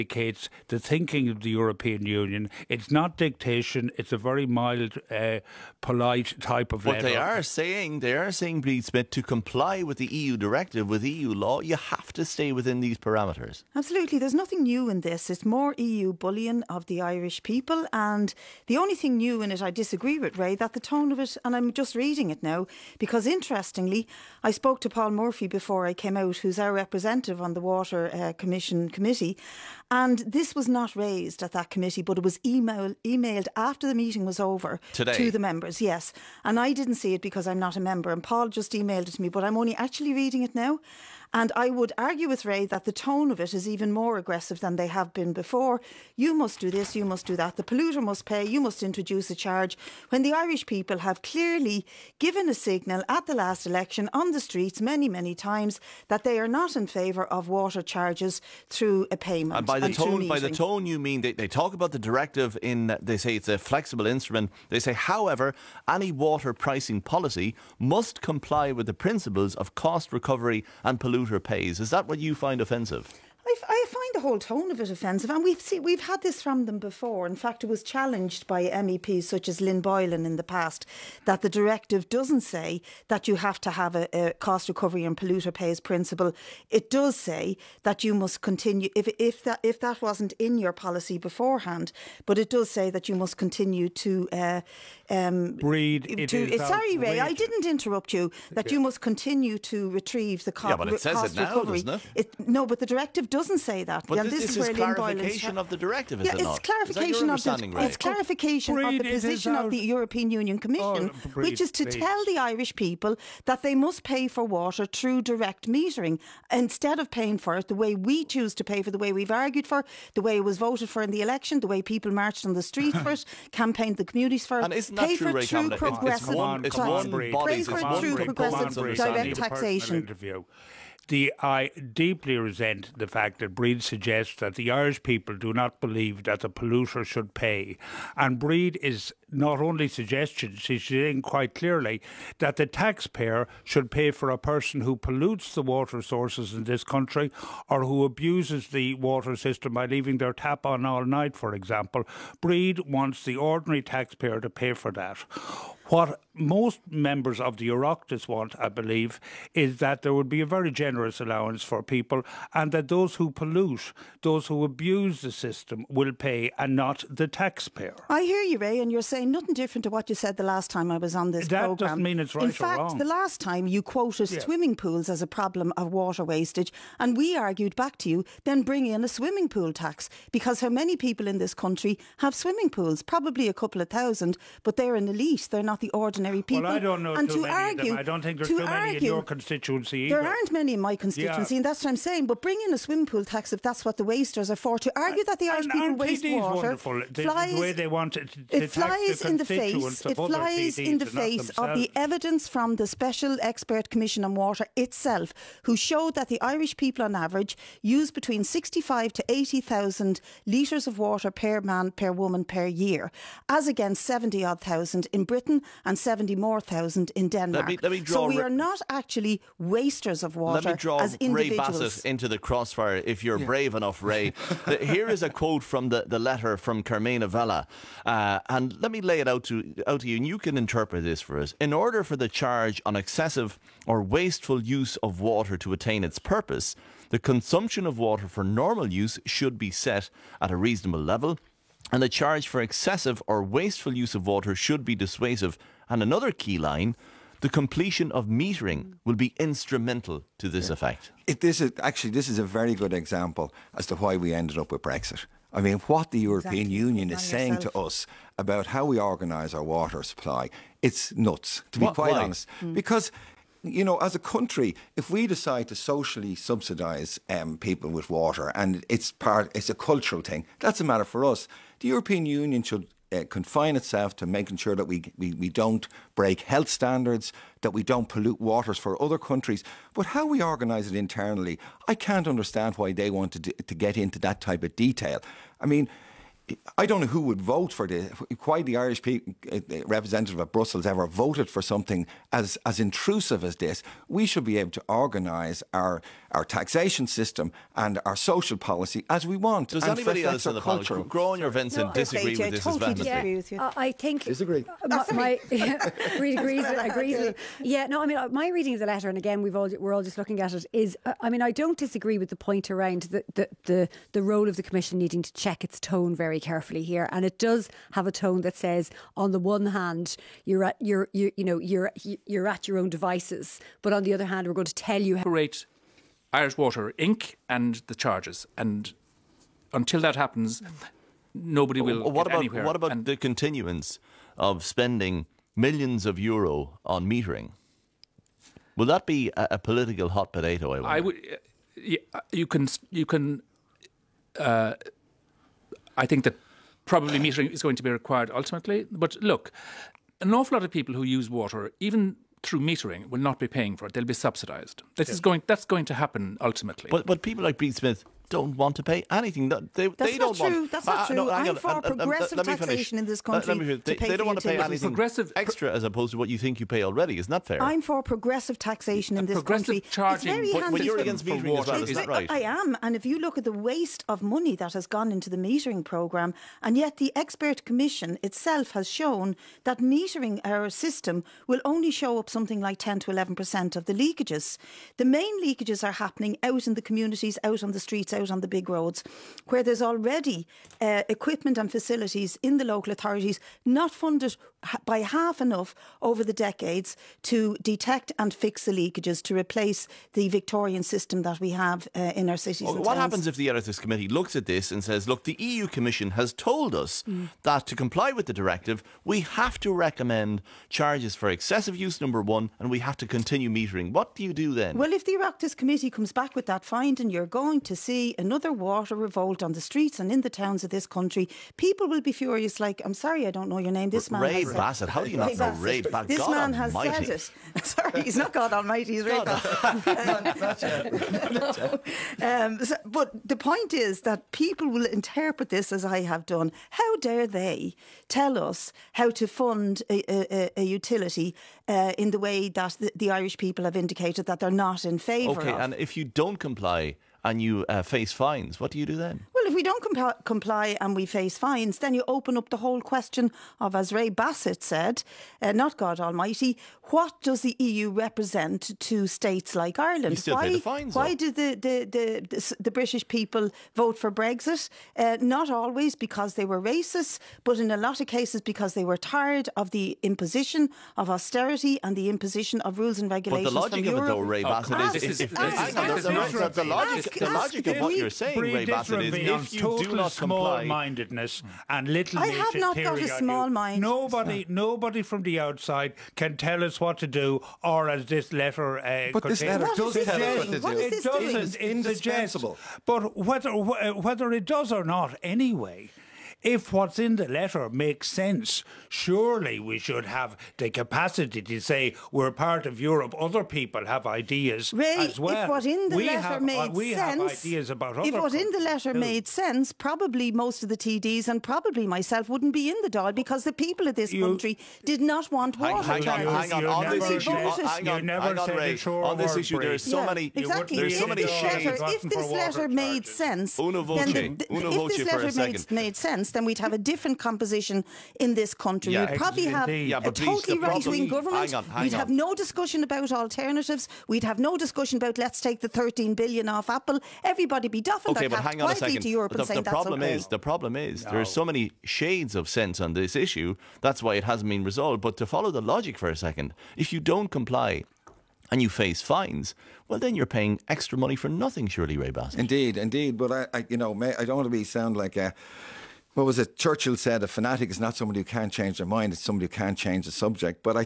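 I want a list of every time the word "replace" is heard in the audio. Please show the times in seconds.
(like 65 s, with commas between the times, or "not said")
399 s.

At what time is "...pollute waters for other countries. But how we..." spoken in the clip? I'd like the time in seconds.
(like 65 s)
278 s.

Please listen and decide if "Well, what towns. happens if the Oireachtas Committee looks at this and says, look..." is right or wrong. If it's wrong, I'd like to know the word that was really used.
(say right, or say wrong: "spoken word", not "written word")
right.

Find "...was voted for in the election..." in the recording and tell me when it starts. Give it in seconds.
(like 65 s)
120 s.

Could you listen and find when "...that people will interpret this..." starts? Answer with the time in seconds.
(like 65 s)
434 s.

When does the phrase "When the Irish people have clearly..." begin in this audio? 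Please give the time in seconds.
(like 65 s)
50 s.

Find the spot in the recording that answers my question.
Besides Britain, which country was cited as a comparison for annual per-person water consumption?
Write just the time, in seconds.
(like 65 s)
217 s.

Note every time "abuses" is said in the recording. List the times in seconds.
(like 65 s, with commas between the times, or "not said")
148 s, 164 s.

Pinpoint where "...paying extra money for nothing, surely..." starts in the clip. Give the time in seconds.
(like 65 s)
550 s.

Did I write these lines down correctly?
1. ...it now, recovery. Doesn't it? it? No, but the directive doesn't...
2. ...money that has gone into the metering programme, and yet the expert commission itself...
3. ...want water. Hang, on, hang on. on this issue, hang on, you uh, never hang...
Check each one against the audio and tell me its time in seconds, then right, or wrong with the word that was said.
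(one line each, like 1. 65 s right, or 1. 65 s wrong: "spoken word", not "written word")
1. 101 s right
2. 374 s right
3. 515 s right.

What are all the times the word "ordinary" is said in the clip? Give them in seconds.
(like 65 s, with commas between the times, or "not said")
153 s, 185 s.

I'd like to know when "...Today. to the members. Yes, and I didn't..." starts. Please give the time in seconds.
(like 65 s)
34 s.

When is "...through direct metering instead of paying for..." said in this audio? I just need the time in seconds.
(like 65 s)
114 s.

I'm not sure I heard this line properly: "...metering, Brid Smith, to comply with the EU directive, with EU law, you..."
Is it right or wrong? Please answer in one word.
wrong.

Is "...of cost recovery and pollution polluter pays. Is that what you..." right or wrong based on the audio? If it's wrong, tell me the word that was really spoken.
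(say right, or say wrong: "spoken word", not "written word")
right.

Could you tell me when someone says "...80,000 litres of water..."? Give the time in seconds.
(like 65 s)
209 s.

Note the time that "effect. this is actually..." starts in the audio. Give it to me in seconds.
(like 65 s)
250 s.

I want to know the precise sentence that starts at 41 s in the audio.
And I would argue with Ray that the tone of it is even more aggressive than they have been before.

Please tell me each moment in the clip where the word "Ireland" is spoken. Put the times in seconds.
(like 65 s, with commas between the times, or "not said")
459 s.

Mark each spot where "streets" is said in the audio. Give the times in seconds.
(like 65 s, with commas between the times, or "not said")
54 s, 122 s, 387 s, 419 s.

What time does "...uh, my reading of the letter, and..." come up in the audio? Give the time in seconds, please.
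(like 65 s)
308 s.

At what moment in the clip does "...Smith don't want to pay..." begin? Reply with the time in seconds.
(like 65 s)
357 s.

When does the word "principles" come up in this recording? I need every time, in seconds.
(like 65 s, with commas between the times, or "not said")
68 s, 85 s.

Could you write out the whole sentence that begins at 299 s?
Does anybody else in the culture, Grown your Vincent, no, disagree with I this?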